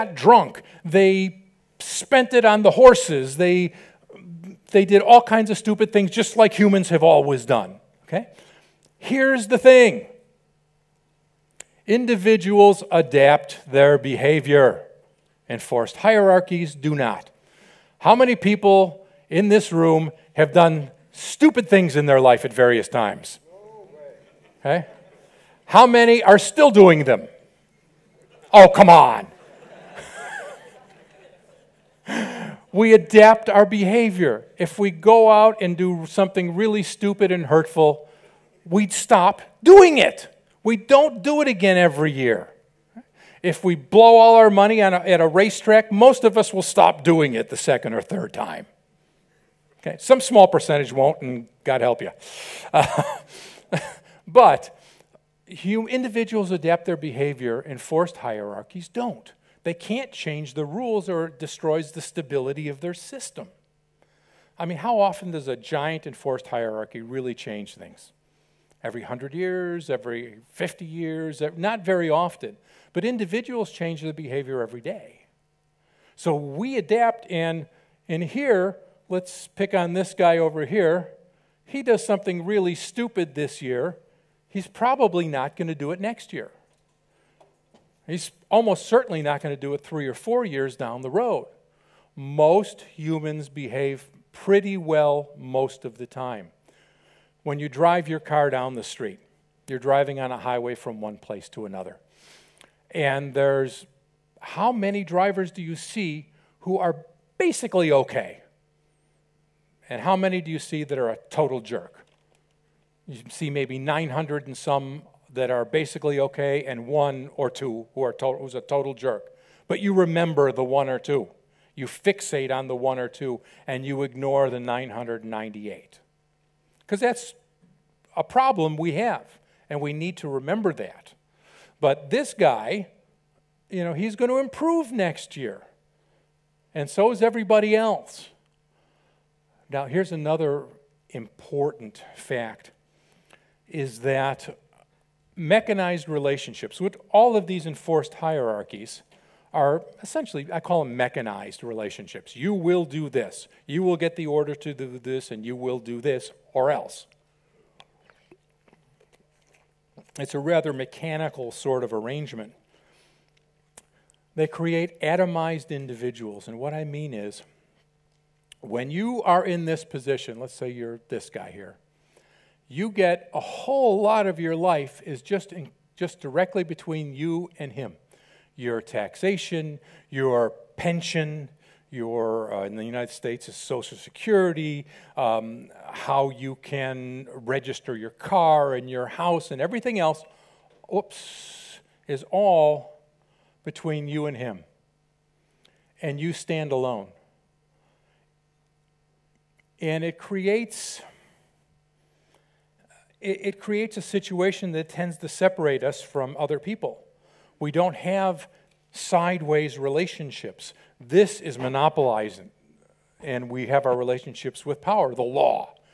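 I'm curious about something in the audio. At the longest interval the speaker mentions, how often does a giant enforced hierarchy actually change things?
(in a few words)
Every 100 years.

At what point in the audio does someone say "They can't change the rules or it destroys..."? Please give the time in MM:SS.
00:59.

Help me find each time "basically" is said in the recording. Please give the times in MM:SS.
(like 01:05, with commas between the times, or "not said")
01:47, 01:55.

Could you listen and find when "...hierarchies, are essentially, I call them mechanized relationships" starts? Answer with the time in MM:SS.
02:28.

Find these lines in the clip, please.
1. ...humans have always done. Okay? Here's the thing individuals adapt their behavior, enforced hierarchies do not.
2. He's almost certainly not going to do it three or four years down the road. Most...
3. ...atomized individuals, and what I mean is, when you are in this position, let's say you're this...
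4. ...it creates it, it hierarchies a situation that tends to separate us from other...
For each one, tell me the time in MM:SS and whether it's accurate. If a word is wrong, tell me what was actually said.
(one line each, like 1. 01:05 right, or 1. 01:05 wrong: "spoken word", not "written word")
1. 00:06 right
2. 01:28 right
3. 02:45 right
4. 03:20 wrong: "creates", not "hierarchies".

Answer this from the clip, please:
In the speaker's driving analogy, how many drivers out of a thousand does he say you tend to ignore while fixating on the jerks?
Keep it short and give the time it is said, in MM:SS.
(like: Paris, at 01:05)
998, at 02:04.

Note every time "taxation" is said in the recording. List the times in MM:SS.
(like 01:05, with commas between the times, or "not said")
02:58.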